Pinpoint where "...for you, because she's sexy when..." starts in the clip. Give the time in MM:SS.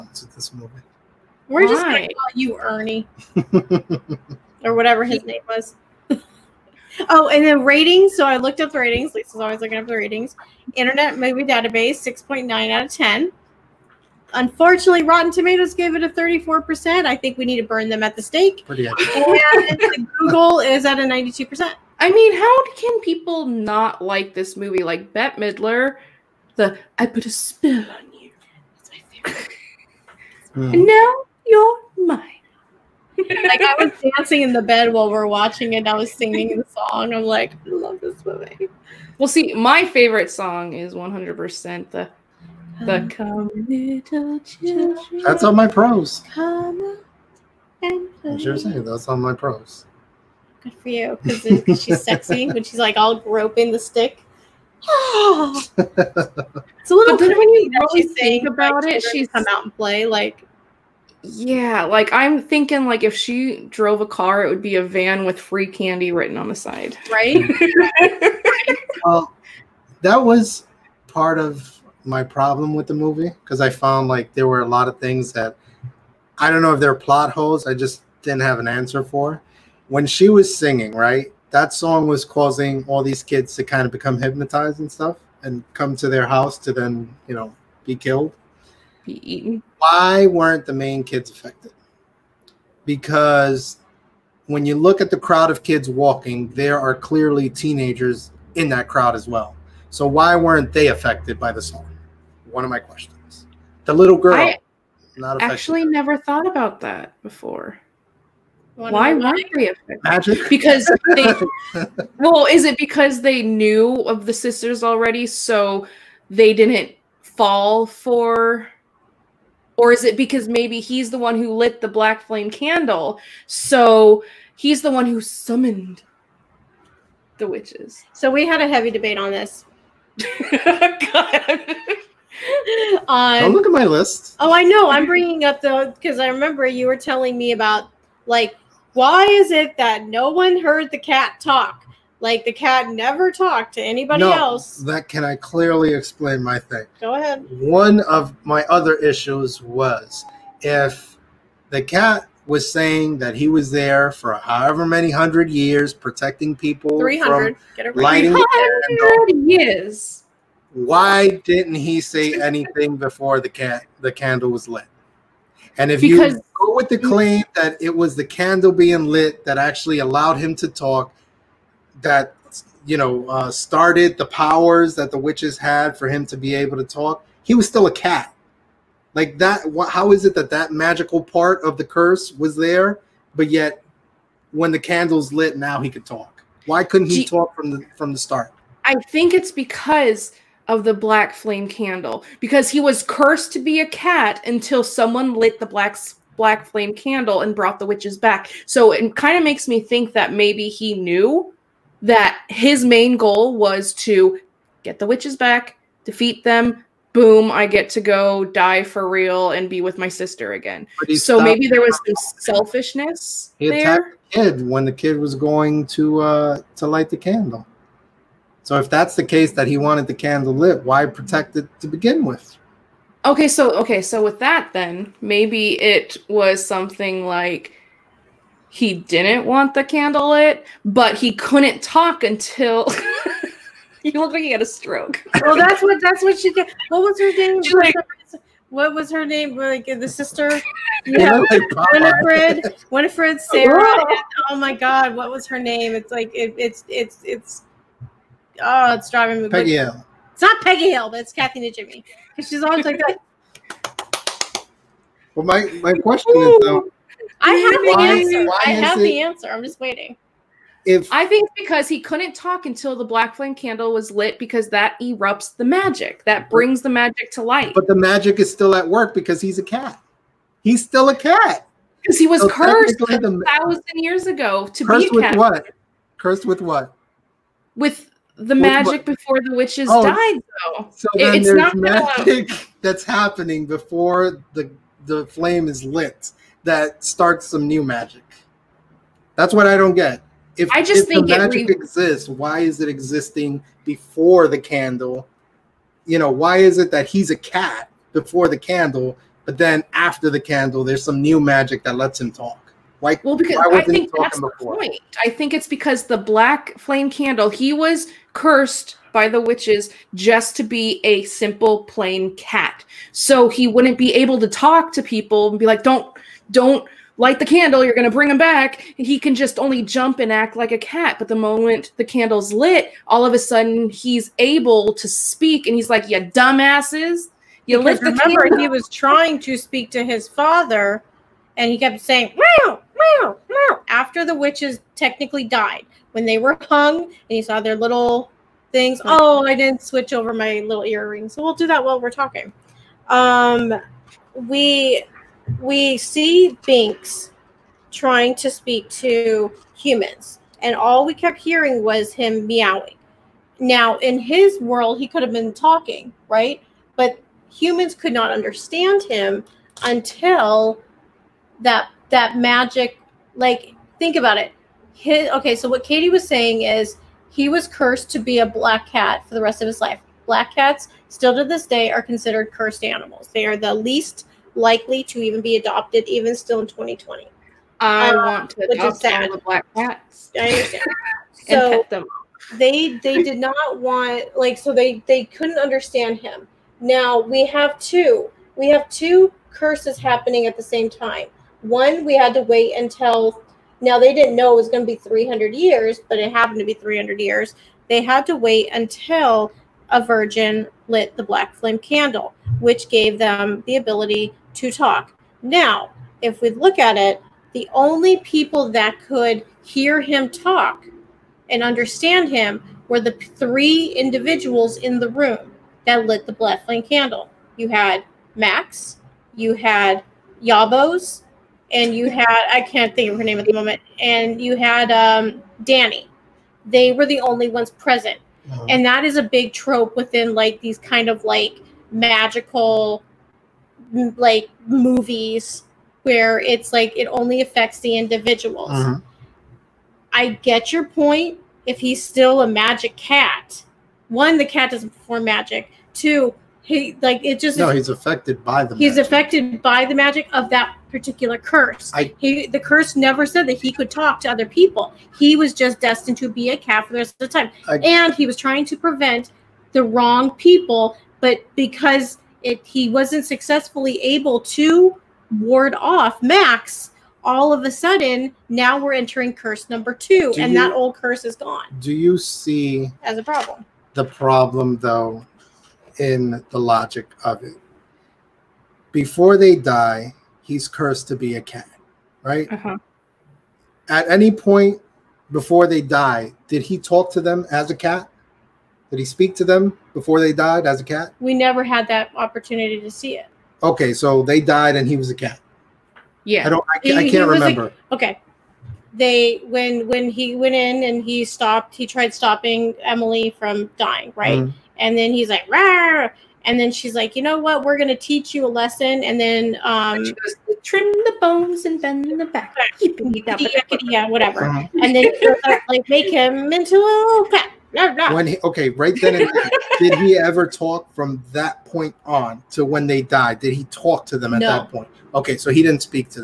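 00:50.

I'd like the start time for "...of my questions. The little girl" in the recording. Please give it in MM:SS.
01:42.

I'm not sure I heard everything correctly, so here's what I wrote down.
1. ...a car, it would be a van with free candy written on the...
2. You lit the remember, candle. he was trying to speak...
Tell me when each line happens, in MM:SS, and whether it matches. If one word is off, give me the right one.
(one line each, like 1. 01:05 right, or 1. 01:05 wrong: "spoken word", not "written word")
1. 01:03 right
2. 05:27 right.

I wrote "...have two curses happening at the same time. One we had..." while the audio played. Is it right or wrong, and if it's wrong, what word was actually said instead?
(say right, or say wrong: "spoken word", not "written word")
right.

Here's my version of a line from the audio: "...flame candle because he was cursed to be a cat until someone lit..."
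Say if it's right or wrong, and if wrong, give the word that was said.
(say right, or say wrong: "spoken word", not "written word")
right.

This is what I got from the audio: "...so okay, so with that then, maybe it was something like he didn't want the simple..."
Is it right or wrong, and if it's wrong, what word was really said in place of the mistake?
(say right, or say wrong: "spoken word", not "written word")
wrong: "candle", not "simple".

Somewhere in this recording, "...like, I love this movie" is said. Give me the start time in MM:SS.
00:37.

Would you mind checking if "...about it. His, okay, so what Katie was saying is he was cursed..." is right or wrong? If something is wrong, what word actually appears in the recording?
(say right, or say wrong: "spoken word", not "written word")
right.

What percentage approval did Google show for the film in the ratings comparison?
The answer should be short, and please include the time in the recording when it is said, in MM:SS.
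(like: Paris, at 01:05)
92%, at 00:21.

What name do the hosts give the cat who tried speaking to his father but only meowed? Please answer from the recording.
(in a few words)
Binks.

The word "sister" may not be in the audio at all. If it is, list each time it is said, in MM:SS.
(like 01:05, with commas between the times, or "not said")
01:54, 03:30, 04:00.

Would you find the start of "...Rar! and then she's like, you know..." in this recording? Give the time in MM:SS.
08:25.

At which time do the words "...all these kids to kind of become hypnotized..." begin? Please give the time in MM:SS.
01:22.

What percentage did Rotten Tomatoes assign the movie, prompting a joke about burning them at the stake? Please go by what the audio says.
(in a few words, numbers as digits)
34%.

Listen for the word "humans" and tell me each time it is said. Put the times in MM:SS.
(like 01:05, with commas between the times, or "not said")
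05:49, 05:57.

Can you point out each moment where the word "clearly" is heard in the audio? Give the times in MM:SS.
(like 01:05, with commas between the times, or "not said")
01:36, 02:25.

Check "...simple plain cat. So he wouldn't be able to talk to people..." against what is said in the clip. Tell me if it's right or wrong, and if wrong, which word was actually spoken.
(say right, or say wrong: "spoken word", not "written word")
right.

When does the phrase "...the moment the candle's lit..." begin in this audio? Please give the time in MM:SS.
05:21.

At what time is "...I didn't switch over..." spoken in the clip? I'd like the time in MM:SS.
05:39.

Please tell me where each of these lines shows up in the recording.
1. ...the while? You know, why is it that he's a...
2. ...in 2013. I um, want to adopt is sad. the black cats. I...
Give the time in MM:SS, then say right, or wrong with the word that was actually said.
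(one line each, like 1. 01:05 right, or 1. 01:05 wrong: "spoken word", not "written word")
1. 04:54 wrong: "candle", not "while"
2. 06:16 wrong: "2020", not "2013".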